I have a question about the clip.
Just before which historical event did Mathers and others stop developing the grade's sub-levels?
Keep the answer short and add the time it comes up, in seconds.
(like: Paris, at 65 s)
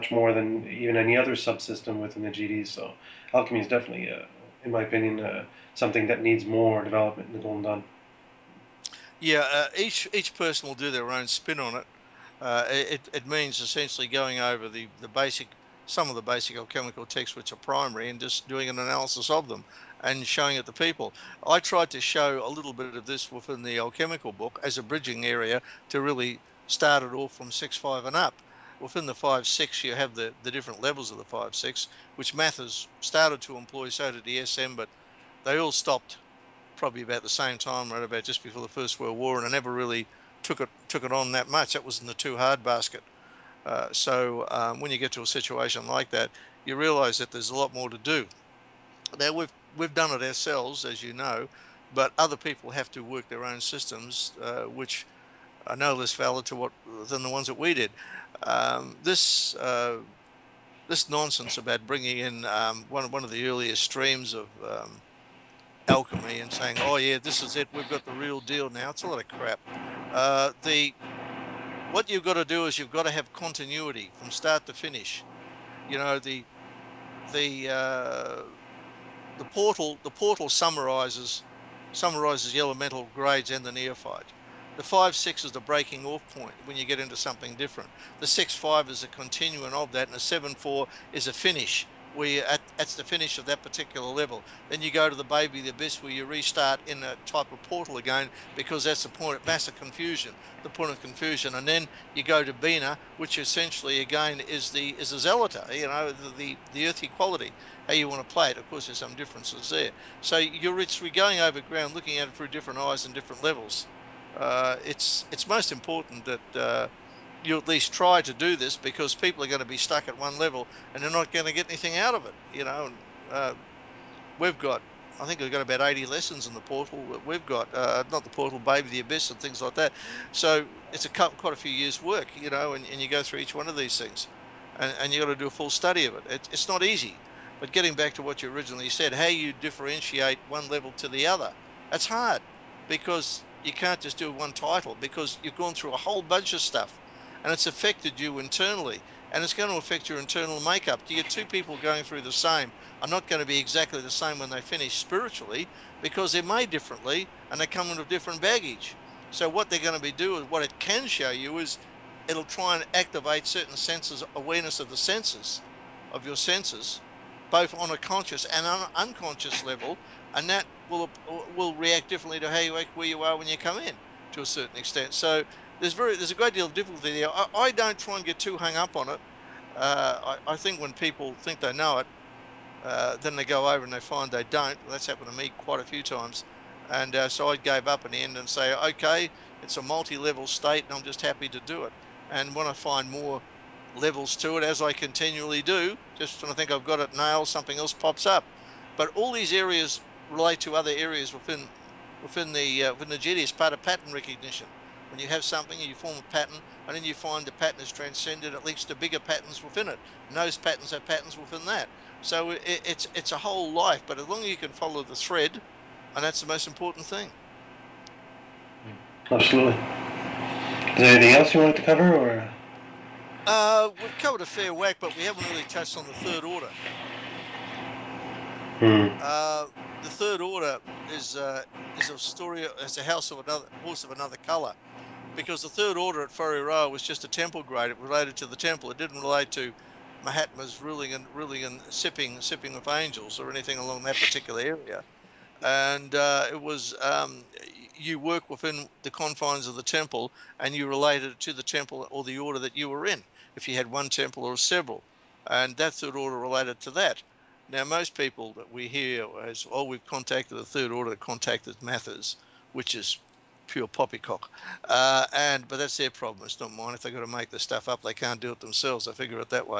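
First World War, at 38 s.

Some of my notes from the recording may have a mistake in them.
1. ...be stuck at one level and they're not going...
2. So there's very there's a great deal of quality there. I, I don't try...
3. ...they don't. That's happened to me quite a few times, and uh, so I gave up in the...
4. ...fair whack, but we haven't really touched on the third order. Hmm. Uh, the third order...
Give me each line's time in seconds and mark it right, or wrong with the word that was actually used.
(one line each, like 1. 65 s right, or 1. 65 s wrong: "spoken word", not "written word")
1. 119 s right
2. 175 s wrong: "difficulty", not "quality"
3. 184 s right
4. 224 s right.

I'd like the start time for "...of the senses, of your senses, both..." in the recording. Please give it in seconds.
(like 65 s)
164 s.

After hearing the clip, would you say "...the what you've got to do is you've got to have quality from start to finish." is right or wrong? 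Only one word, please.
wrong.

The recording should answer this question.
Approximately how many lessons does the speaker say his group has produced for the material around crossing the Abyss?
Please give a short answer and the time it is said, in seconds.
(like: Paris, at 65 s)
80, at 125 s.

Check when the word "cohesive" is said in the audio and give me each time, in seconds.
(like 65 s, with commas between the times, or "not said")
not said.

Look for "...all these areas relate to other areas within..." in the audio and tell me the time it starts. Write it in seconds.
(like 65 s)
199 s.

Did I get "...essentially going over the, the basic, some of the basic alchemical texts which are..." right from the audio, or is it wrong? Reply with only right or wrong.
right.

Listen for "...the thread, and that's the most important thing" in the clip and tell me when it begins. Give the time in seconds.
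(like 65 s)
215 s.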